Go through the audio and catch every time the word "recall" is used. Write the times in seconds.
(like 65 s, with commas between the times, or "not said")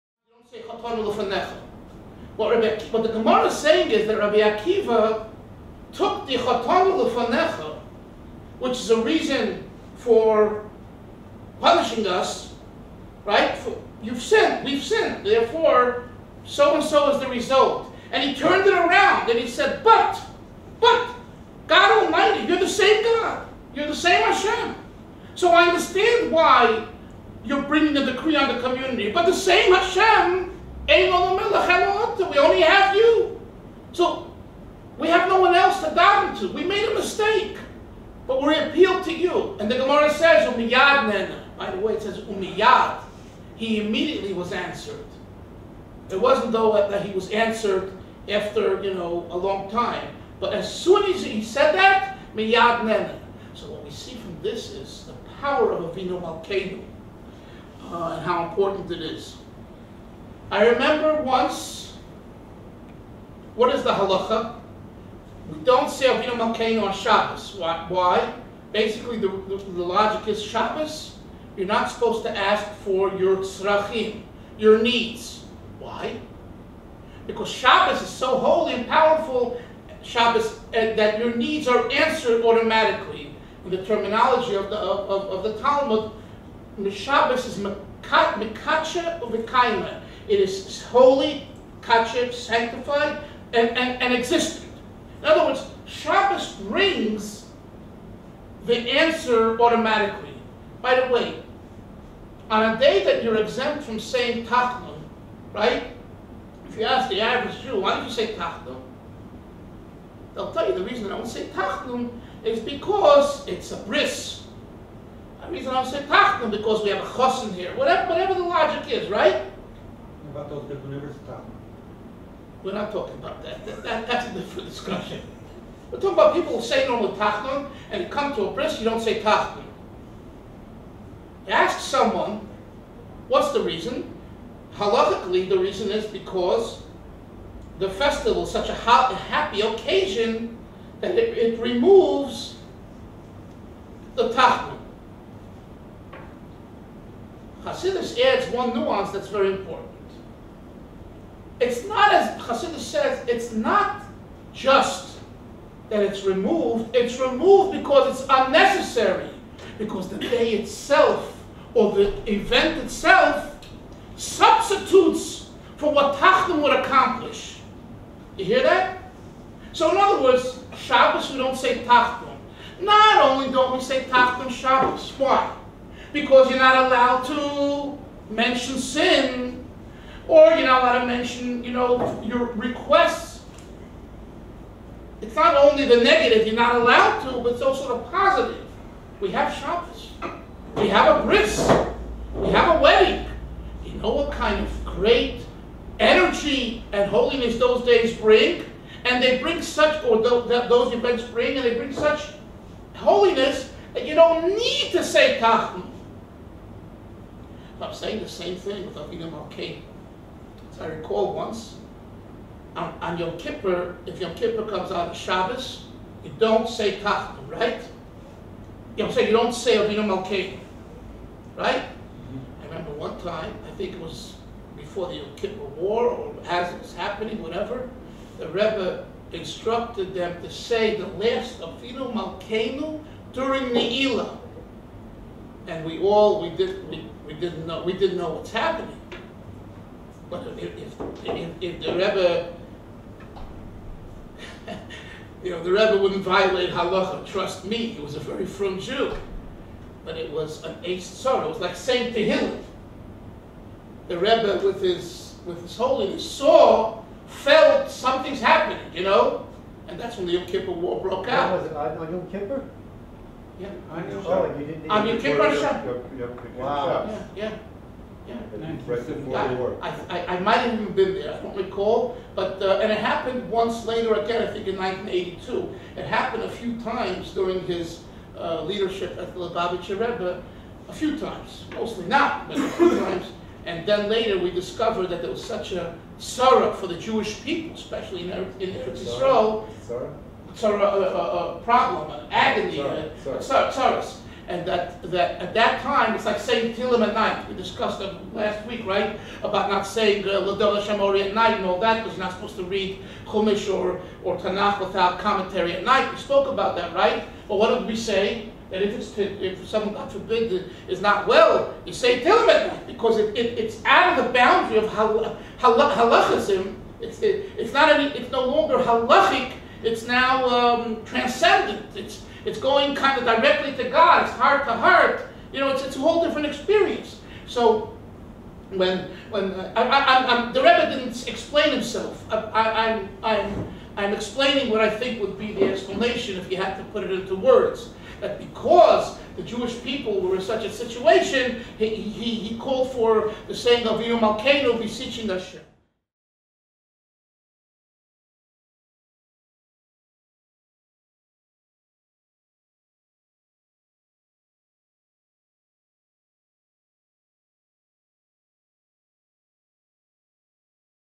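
210 s, 271 s.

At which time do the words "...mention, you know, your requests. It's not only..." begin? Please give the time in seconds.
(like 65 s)
181 s.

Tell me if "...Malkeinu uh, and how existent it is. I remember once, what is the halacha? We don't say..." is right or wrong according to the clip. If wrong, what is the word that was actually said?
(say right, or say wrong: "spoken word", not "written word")
wrong: "important", not "existent".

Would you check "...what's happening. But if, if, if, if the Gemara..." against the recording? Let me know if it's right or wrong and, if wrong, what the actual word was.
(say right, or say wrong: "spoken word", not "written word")
wrong: "Rebbe", not "Gemara".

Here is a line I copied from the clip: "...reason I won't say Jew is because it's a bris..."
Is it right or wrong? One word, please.
wrong.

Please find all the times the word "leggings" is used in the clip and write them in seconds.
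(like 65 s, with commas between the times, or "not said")
not said.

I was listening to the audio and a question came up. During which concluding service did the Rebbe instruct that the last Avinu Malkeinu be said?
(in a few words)
Ne'ilah.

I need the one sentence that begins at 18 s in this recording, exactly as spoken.
And he turned it around and he said, But, but, God Almighty, you're the same God, you're the same Hashem.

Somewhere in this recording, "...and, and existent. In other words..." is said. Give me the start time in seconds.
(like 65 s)
93 s.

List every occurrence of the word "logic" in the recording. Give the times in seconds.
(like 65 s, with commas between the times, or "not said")
69 s, 118 s.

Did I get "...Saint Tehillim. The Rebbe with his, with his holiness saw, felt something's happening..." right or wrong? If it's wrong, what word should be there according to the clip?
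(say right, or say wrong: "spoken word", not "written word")
right.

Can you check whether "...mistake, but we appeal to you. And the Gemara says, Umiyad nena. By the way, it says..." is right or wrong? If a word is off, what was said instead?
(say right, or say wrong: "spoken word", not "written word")
right.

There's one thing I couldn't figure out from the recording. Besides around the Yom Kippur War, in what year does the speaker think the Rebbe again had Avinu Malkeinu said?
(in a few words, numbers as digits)
1982.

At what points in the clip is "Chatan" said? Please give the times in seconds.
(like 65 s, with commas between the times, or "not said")
6 s.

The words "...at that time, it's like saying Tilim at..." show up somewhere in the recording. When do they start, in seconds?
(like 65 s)
295 s.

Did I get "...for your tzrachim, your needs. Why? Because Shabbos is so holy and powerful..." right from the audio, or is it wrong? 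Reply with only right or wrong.
right.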